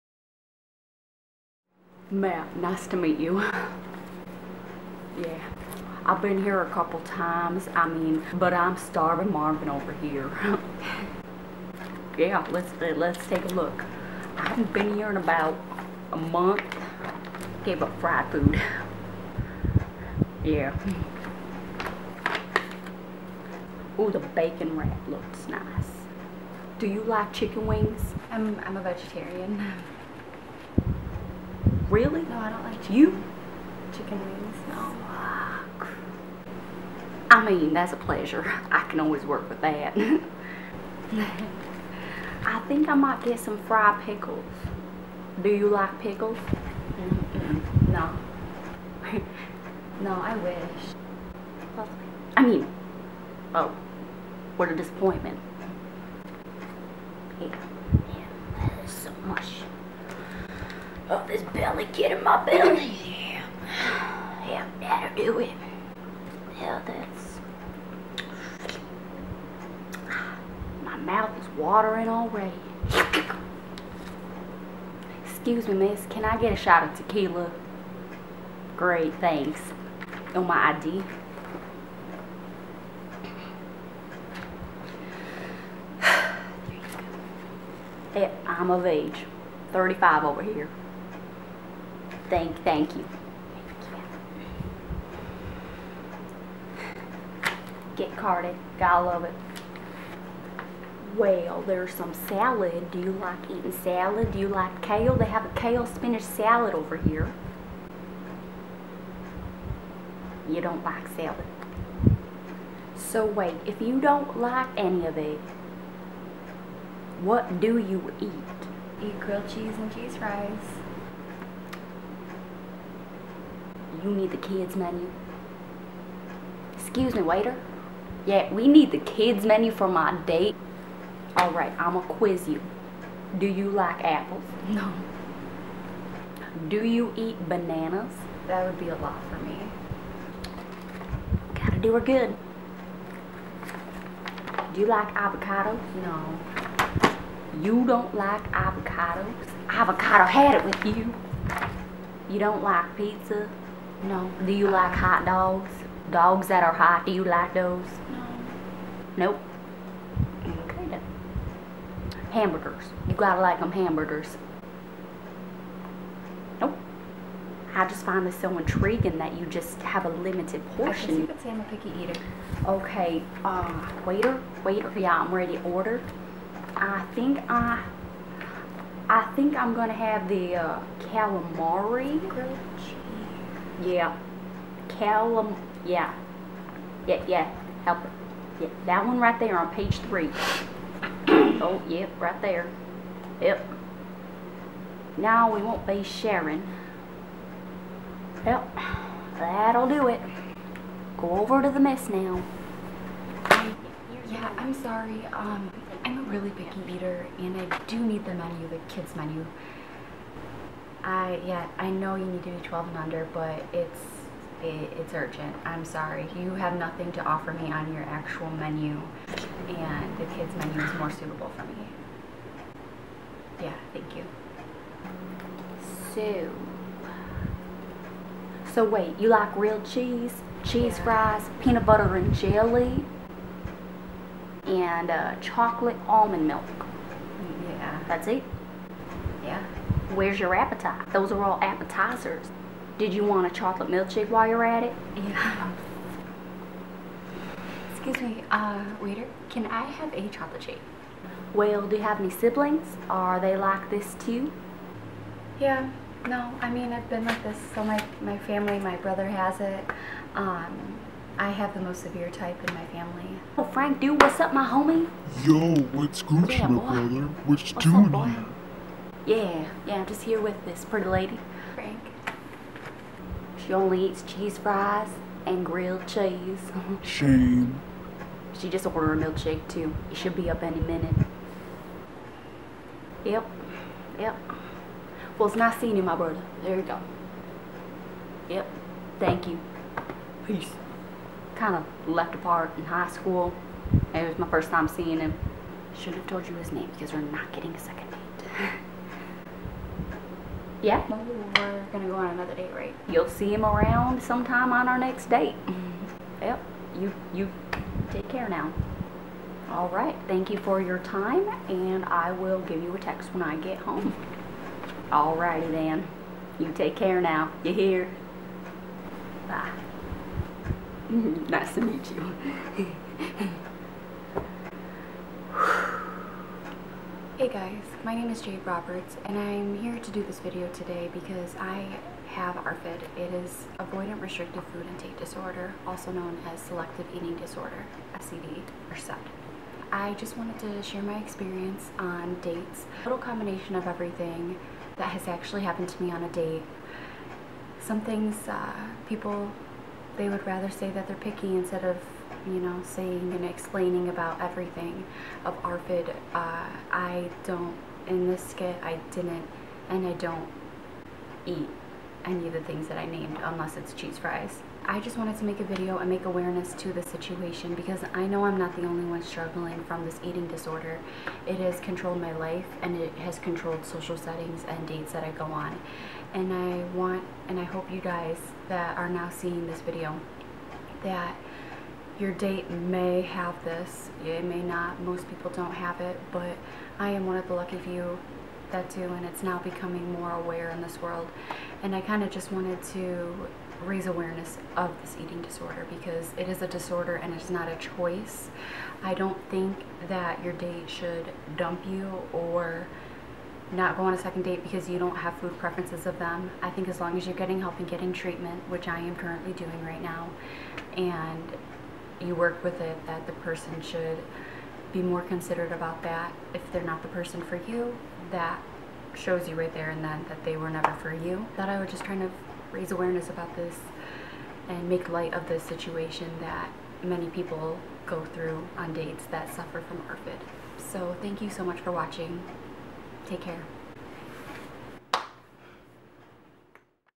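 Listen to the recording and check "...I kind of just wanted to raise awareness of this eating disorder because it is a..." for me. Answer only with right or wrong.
right.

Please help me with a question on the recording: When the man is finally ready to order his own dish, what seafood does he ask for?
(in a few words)
calamari.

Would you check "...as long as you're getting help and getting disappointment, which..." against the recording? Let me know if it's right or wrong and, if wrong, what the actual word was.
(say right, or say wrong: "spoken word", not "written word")
wrong: "treatment", not "disappointment".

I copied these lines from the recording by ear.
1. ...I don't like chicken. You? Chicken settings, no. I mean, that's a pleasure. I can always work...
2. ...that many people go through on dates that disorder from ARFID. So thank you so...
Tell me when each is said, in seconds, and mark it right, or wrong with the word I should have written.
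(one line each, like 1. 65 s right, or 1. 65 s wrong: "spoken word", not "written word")
1. 32 s wrong: "wings", not "settings"
2. 426 s wrong: "suffer", not "disorder".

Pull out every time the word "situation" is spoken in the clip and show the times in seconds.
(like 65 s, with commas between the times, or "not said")
367 s, 425 s.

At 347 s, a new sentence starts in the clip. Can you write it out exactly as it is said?
Some things uh, people, they would rather say that they're picky instead of you know, saying and explaining about everything of ARFID.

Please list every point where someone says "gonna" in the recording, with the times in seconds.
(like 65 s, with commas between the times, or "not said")
179 s, 301 s.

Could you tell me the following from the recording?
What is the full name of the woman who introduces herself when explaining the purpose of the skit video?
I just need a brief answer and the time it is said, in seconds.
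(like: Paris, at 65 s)
Jaide Roberts, at 328 s.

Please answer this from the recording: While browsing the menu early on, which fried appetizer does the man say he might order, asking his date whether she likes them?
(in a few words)
fried pickles.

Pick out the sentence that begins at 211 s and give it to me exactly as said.
I yeah, I know you need to be 12 and under, but it's it, it's urgent.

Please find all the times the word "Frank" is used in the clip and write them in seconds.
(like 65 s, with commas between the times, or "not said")
263 s, 271 s.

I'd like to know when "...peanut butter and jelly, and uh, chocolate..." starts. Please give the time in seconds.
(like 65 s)
231 s.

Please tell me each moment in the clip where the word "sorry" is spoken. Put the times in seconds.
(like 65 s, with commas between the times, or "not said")
204 s, 215 s.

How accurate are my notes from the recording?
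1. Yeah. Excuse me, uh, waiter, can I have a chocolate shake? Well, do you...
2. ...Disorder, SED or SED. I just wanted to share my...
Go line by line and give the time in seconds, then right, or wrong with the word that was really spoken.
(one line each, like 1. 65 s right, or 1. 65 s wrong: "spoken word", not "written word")
1. 245 s right
2. 337 s right.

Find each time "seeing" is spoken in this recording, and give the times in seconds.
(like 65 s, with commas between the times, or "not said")
285 s, 294 s, 379 s.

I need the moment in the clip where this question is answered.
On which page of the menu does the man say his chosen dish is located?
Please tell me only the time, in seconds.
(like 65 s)
189 s.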